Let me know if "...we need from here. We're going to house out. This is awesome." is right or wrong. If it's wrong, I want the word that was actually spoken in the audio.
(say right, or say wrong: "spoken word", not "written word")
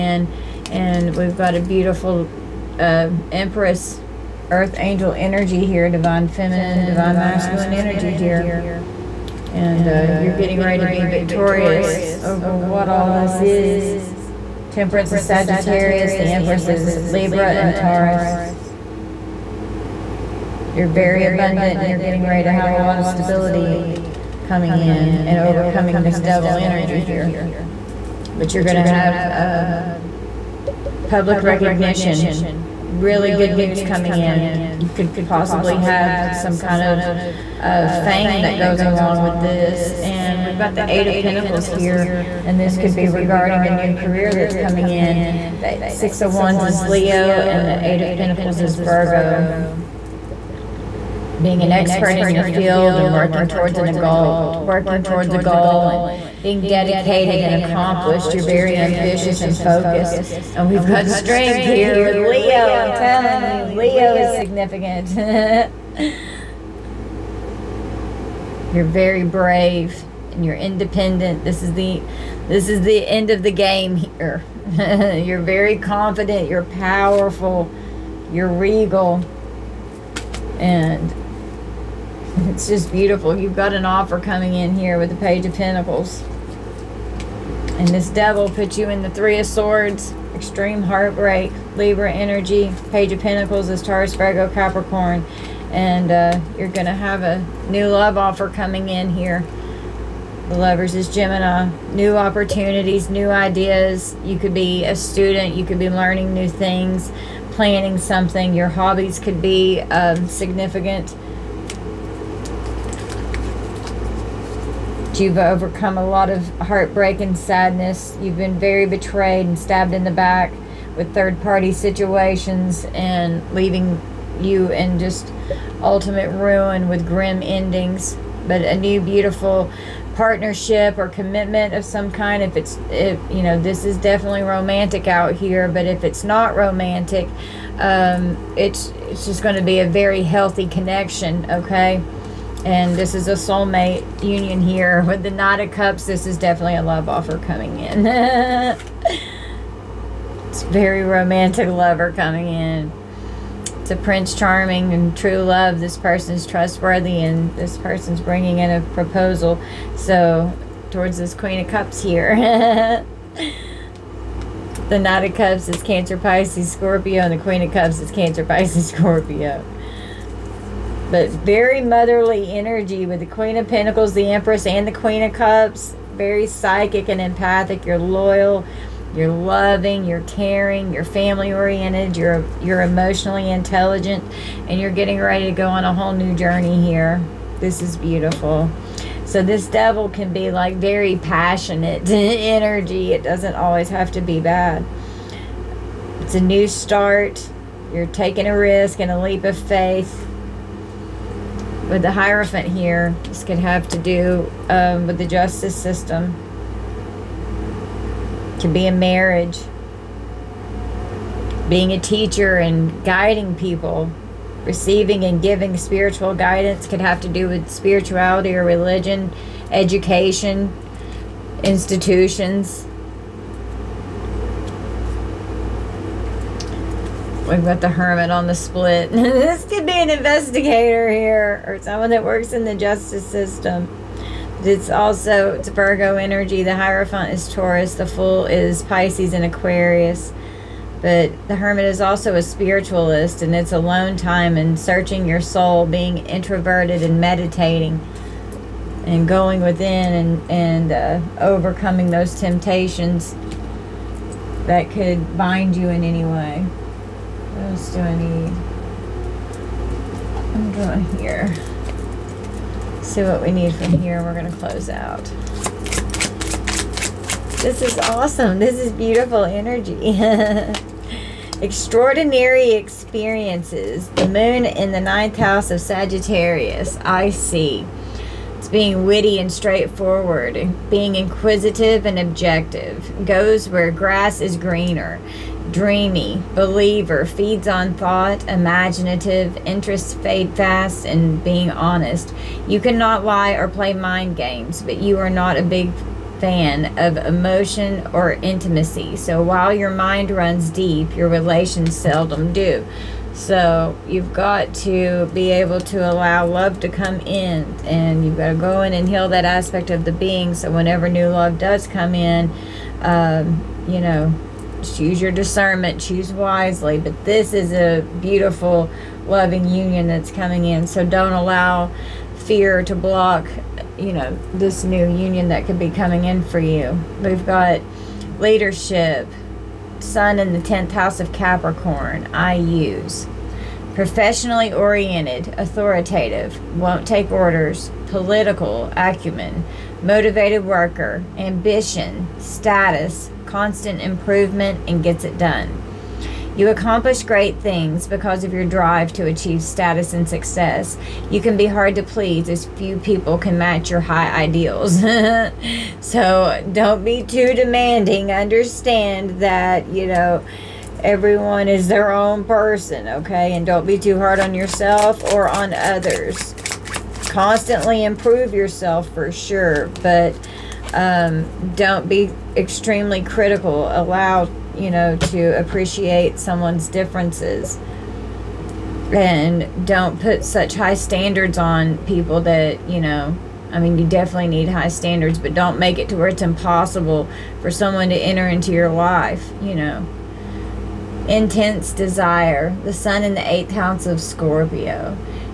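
wrong: "close", not "house".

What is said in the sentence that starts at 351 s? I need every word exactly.
You can be hard to please as few people can match your high ideals.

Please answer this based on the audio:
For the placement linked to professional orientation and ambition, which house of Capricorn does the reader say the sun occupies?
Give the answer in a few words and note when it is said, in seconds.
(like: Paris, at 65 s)
10th house, at 330 s.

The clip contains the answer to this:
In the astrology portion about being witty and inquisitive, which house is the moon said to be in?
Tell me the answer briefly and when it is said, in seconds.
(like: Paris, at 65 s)
Ninth house, at 275 s.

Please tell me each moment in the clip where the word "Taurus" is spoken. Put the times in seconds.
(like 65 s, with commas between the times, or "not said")
17 s, 93 s, 237 s.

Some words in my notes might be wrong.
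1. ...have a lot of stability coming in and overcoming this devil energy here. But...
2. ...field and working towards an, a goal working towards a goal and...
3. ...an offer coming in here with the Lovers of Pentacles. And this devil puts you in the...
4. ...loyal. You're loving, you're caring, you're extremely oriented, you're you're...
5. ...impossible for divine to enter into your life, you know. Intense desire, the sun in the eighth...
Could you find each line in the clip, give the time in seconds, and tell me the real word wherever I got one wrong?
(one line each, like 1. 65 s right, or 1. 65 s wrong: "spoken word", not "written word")
1. 22 s right
2. 52 s right
3. 83 s wrong: "Page", not "Lovers"
4. 177 s wrong: "family", not "extremely"
5. 386 s wrong: "someone", not "divine".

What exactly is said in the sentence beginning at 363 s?
And don't be too hard on yourself or on others.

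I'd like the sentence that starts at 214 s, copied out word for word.
Receiving and giving spiritual guidance could have to do with spirituality or religion, education, institutions.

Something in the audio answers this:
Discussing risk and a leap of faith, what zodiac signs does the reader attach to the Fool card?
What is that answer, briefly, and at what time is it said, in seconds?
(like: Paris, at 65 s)
Pisces and Aquarius, at 238 s.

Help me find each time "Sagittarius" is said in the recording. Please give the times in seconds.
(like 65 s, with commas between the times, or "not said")
15 s, 275 s.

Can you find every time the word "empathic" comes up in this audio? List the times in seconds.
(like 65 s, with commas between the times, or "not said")
177 s.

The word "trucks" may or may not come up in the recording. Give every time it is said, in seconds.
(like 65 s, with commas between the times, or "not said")
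not said.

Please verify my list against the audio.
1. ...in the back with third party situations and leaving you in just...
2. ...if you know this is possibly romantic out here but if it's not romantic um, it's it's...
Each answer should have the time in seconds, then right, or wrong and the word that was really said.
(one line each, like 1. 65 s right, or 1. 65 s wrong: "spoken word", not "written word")
1. 119 s right
2. 132 s wrong: "definitely", not "possibly".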